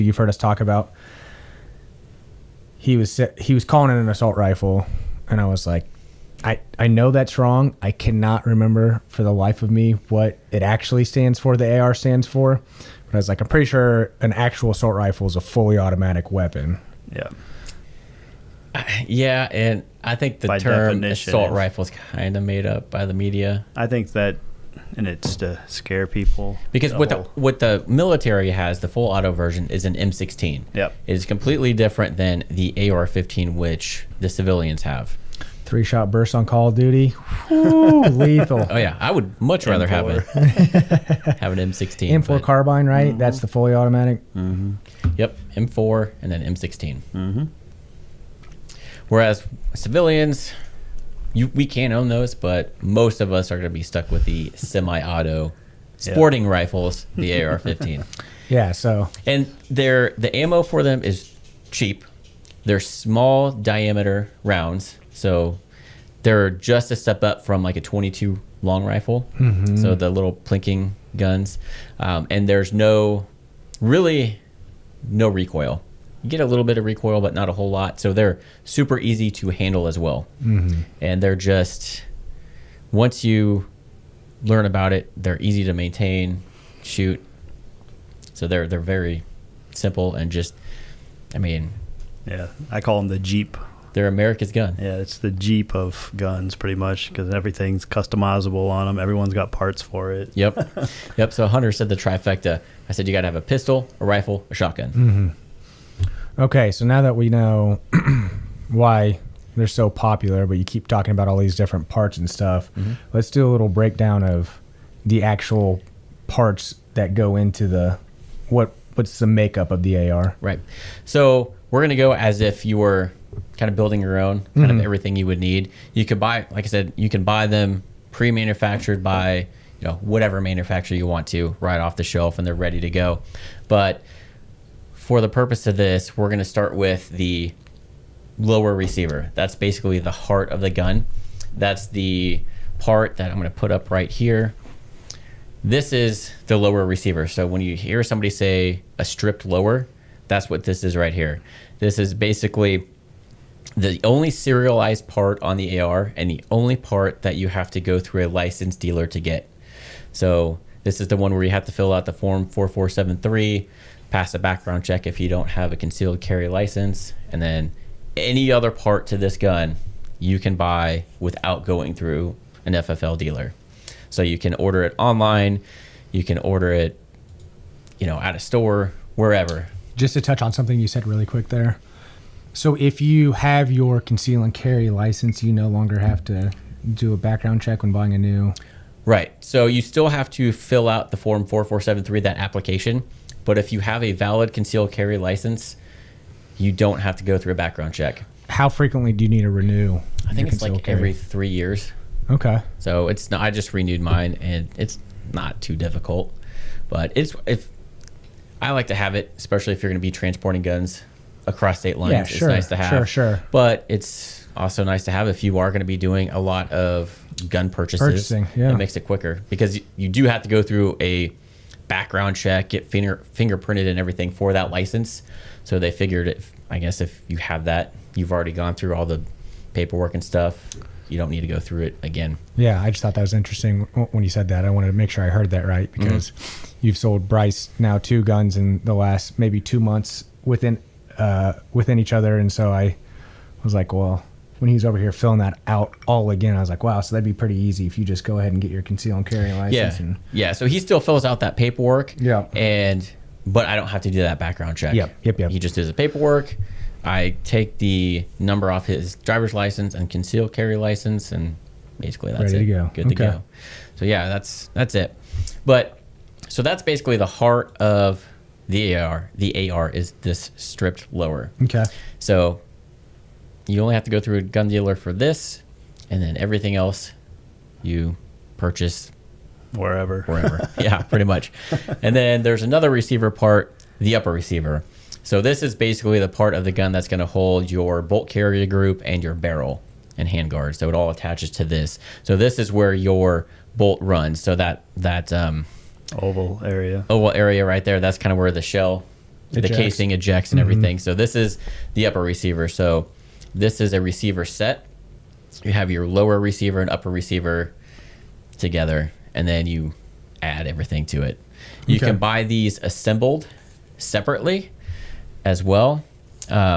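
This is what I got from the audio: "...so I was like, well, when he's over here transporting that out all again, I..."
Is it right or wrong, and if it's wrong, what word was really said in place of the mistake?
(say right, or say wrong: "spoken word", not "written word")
wrong: "filling", not "transporting".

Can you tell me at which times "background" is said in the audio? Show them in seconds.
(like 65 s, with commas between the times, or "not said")
164 s, 187 s, 197 s, 221 s, 254 s.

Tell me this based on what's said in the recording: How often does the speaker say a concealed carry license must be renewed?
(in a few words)
Every 3 years.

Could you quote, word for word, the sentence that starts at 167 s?
And then any other part to this gun you can buy without going through an FFL dealer.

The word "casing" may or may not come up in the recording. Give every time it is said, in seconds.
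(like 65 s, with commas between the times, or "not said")
299 s.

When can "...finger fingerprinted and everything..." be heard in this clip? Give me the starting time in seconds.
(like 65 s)
222 s.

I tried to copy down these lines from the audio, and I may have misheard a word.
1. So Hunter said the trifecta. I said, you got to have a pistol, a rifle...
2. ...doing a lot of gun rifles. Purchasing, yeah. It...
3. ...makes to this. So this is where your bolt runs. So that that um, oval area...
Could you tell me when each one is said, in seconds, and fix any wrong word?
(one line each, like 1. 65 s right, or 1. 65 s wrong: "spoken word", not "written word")
1. 101 s right
2. 215 s wrong: "purchases", not "rifles"
3. 291 s wrong: "attaches", not "makes".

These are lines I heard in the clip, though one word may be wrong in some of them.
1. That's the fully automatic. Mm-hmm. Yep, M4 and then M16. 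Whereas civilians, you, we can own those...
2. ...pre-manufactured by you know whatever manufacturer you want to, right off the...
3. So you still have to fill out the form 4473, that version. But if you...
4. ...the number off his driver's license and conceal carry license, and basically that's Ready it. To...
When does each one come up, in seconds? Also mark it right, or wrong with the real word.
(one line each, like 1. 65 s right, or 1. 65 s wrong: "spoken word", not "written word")
1. 43 s right
2. 128 s right
3. 189 s wrong: "application", not "version"
4. 257 s right.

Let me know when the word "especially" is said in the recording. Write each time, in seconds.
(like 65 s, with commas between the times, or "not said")
209 s.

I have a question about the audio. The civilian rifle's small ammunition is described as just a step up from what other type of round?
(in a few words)
22 long rifle.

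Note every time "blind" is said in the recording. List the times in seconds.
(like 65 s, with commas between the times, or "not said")
not said.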